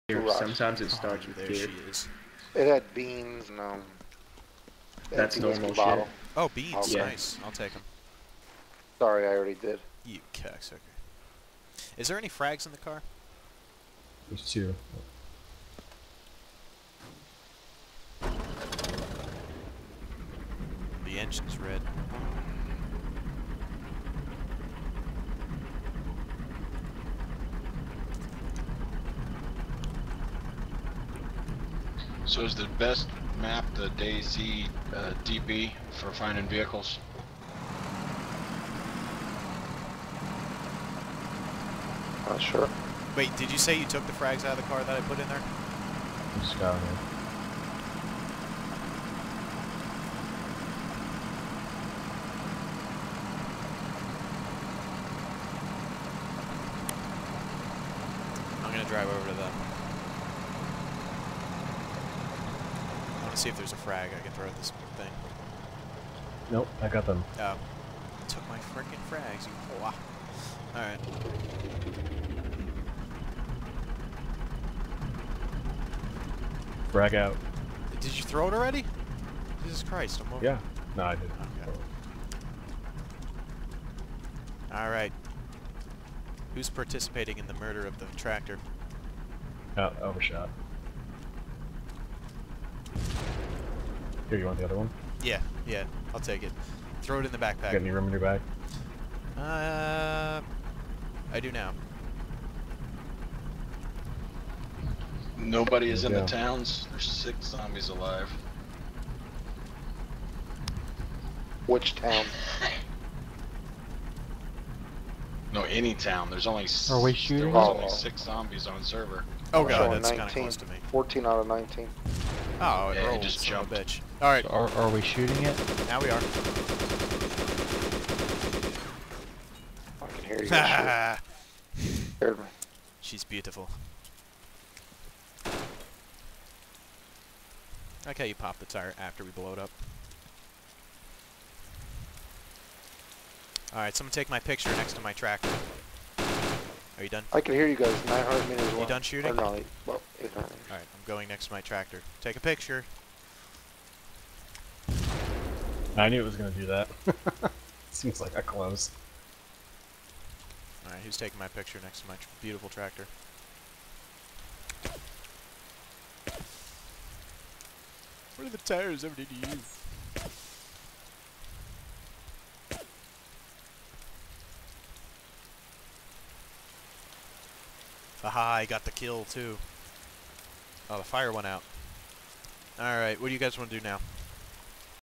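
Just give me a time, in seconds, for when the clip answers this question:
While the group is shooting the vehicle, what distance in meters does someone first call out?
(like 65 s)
148 s.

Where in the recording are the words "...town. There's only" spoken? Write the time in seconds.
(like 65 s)
115 s.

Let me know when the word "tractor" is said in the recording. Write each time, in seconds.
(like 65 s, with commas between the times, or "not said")
88 s, 145 s, 151 s, 162 s.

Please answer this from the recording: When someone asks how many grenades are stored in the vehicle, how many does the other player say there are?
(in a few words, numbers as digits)
2.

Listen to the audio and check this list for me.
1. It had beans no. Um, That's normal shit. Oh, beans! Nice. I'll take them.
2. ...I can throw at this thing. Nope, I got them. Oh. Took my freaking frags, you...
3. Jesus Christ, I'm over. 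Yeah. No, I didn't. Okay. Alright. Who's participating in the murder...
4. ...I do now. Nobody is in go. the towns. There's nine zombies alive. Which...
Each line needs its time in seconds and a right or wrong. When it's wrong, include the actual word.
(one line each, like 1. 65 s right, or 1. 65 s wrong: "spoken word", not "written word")
1. 2 s right
2. 64 s right
3. 79 s right
4. 101 s wrong: "six", not "nine".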